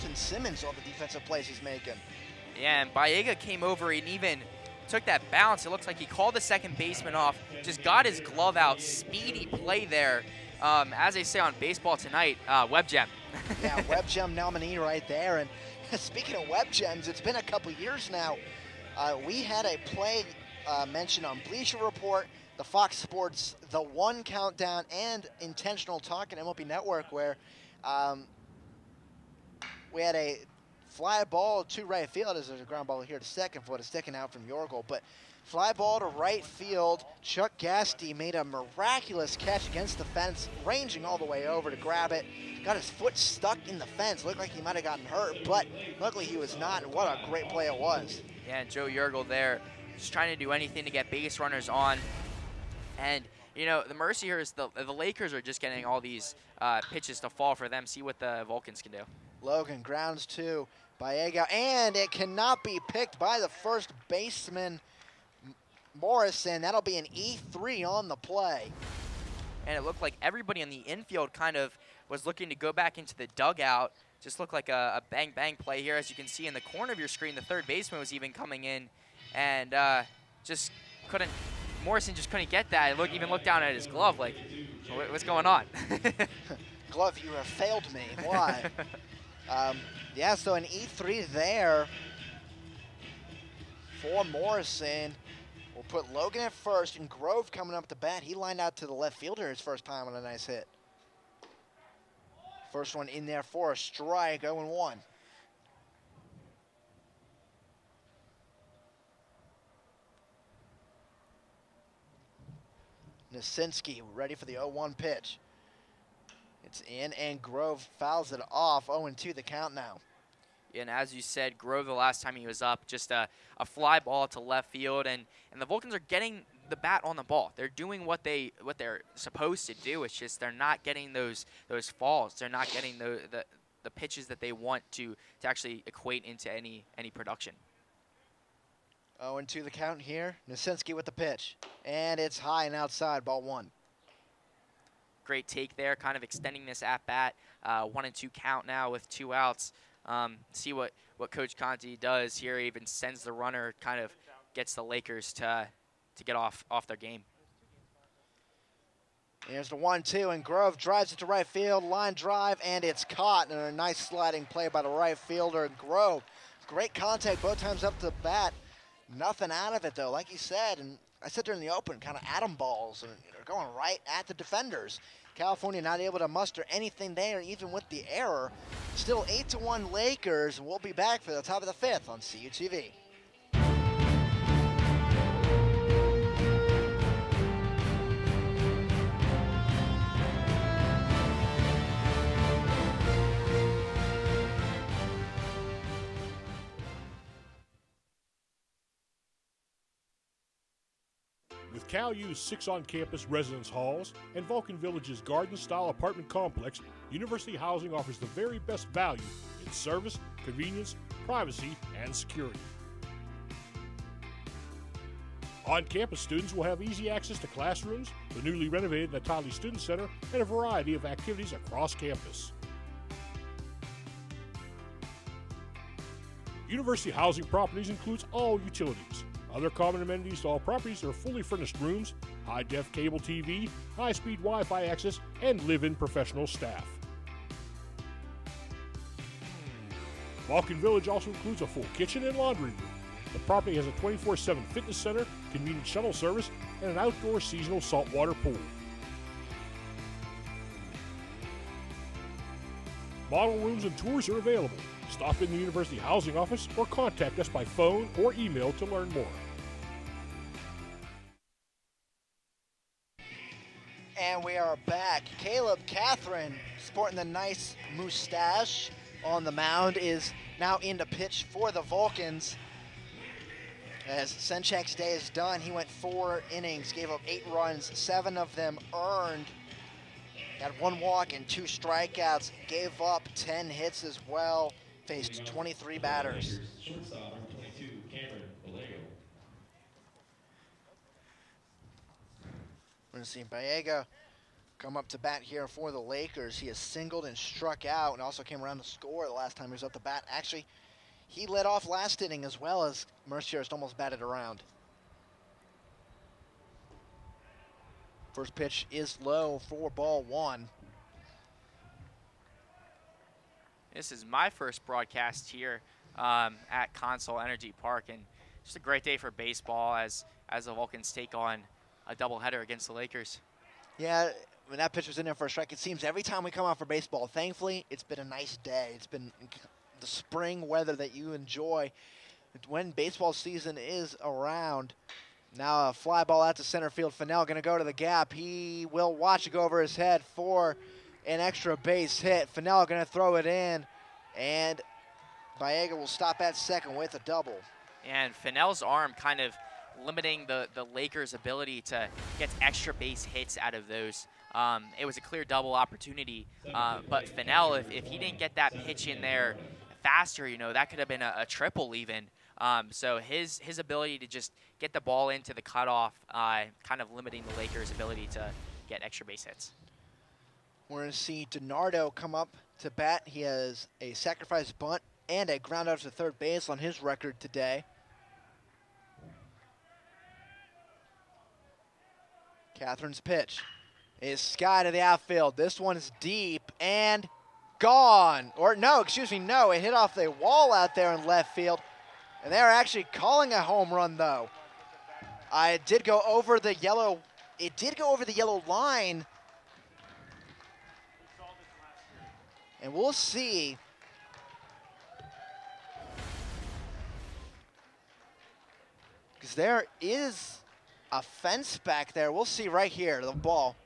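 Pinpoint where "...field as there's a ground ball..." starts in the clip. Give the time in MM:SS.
00:32.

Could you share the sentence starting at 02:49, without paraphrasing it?
Nothing out of it, though, like you said.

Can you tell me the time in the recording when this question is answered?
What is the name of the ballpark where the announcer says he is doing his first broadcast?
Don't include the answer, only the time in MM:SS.
05:16.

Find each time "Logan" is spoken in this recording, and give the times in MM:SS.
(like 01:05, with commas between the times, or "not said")
00:59, 01:36.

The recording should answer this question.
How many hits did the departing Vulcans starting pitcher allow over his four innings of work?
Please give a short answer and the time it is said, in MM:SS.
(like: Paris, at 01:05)
10, at 04:43.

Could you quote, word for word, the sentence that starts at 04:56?
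He has singled and struck out and also came around to score the last time he was up to bat.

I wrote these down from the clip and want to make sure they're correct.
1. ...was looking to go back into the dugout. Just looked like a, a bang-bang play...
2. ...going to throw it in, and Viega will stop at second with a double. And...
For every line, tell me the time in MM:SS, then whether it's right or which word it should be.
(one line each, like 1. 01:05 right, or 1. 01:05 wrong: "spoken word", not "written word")
1. 01:12 right
2. 05:42 right.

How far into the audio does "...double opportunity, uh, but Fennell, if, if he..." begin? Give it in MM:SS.
05:55.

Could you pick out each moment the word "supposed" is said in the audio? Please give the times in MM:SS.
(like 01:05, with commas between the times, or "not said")
02:09.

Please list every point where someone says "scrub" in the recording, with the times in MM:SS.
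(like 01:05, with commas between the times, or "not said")
not said.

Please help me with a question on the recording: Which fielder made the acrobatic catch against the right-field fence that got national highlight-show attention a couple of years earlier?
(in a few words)
Chuck Gasty.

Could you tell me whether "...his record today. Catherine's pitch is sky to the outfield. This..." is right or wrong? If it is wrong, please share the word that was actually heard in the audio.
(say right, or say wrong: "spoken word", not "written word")
right.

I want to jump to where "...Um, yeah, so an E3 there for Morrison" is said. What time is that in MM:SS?
01:29.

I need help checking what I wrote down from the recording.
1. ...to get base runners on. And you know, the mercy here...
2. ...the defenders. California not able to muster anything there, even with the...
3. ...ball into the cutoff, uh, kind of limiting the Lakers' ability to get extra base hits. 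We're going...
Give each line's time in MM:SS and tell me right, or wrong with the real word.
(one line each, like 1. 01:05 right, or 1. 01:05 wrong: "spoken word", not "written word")
1. 00:50 right
2. 02:54 right
3. 06:05 right.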